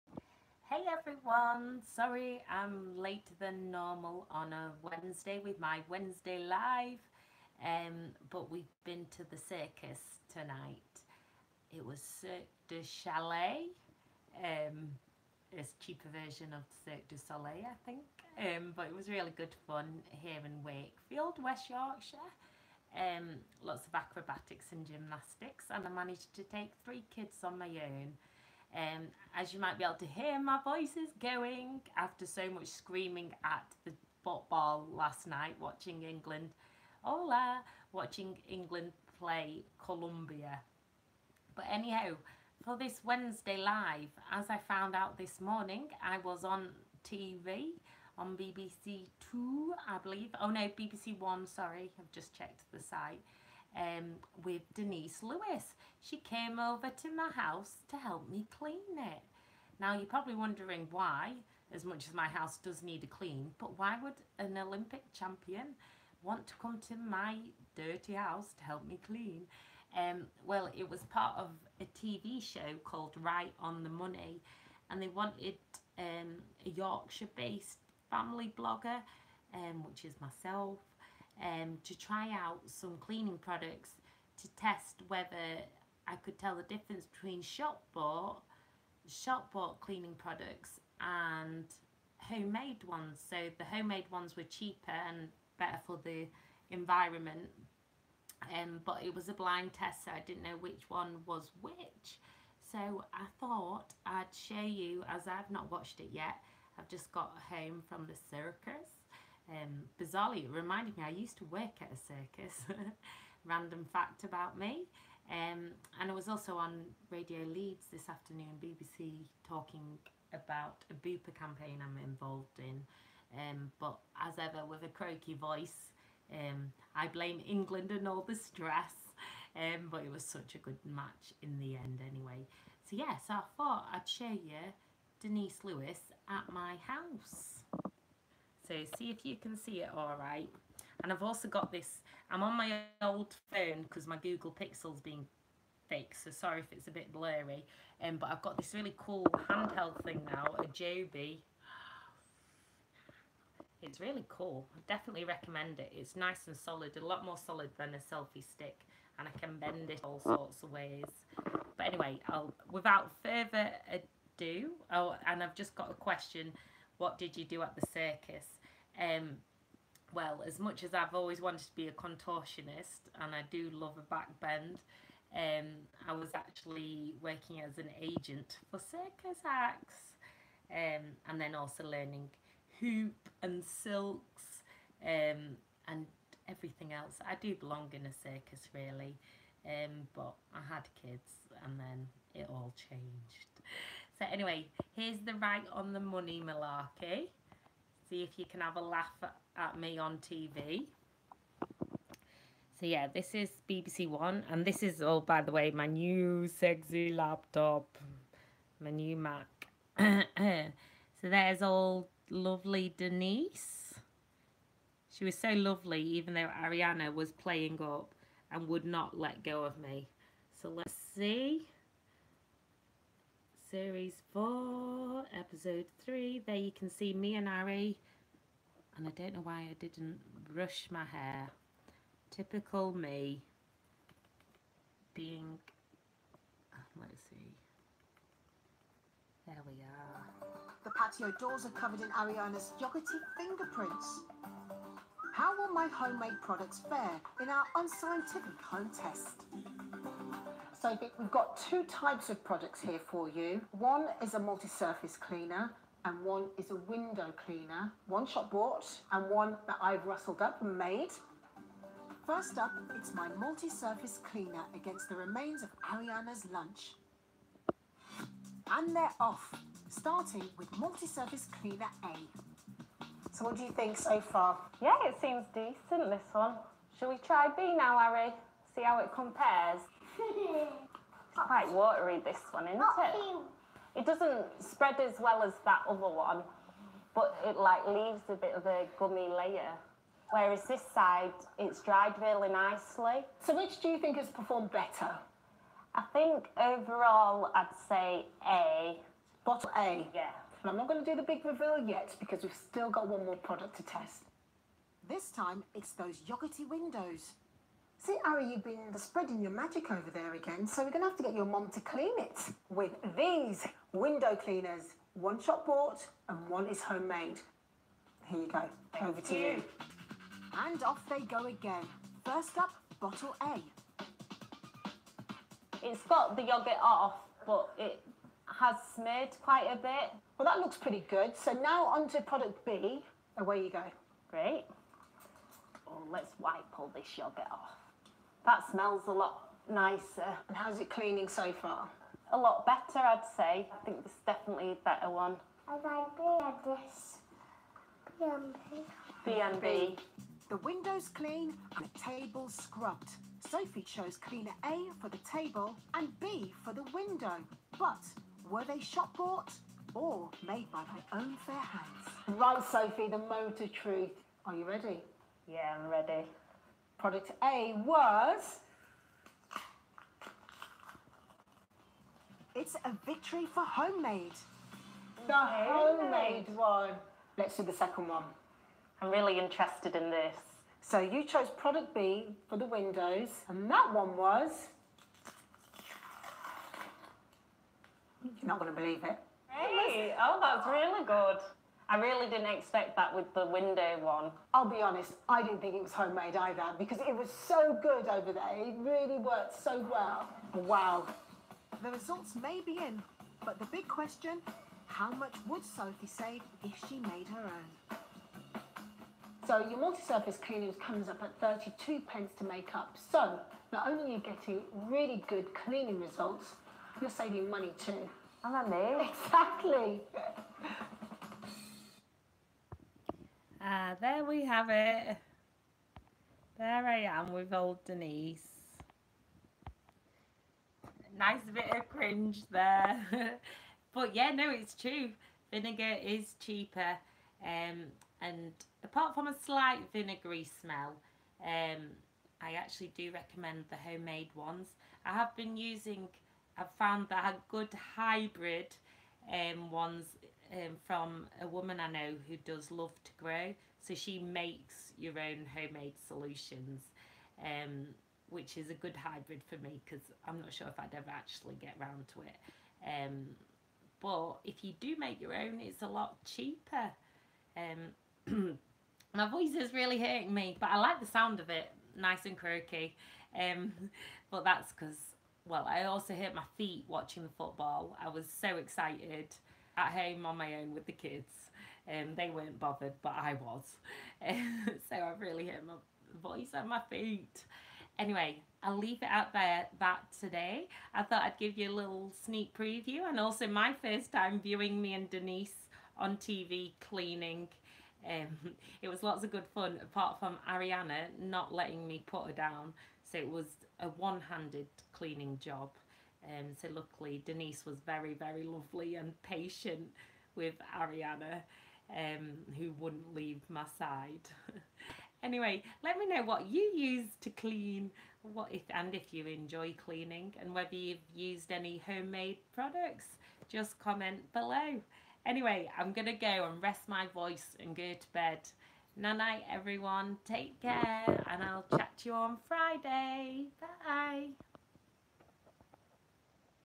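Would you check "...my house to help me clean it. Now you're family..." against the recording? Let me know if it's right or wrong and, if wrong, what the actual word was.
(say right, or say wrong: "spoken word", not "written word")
wrong: "probably", not "family".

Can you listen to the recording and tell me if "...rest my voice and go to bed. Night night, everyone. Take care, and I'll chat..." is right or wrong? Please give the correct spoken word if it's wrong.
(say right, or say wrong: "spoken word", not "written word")
right.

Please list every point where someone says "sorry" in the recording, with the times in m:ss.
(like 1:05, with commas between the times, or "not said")
0:01, 0:51, 2:26.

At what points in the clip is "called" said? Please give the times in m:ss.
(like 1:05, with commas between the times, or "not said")
1:12.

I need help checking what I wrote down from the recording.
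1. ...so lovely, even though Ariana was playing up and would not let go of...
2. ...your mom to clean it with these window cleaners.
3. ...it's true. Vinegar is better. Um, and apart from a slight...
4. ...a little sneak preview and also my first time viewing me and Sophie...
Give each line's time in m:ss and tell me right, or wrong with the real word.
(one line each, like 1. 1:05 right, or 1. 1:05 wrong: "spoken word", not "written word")
1. 3:35 right
2. 5:11 right
3. 7:14 wrong: "cheaper", not "better"
4. 8:11 wrong: "Denise", not "Sophie".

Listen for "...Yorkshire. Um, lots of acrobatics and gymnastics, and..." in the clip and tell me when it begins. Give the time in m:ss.
0:21.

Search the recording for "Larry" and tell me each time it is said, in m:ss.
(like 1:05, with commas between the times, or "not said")
not said.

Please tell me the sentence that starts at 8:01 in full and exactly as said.
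Um, they weren't bothered, but I was.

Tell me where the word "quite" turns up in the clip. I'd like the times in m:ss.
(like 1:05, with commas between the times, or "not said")
4:41, 5:29.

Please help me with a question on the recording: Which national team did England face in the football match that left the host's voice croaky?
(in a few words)
Colombia.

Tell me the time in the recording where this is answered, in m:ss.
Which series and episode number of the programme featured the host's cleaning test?
3:43.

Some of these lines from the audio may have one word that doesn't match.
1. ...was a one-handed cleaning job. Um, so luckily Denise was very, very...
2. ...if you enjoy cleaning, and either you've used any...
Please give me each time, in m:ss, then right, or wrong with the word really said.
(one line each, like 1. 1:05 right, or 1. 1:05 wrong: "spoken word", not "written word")
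1. 8:23 right
2. 8:38 wrong: "whether", not "either".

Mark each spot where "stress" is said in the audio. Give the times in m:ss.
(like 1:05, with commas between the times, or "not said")
2:08.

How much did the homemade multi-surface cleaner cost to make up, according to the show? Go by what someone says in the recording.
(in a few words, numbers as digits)
32 pence.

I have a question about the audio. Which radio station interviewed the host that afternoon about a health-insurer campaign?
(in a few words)
Radio Leeds.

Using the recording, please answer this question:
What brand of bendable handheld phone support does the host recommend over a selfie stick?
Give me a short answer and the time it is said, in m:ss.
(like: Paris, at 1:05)
Joby, at 2:30.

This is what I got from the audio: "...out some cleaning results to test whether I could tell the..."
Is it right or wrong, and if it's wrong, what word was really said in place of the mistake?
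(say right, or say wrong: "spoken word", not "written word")
wrong: "products", not "results".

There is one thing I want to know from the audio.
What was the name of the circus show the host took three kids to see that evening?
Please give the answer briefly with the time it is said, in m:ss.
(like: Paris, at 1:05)
Cirque du Chalet, at 0:12.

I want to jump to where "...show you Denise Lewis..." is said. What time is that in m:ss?
2:14.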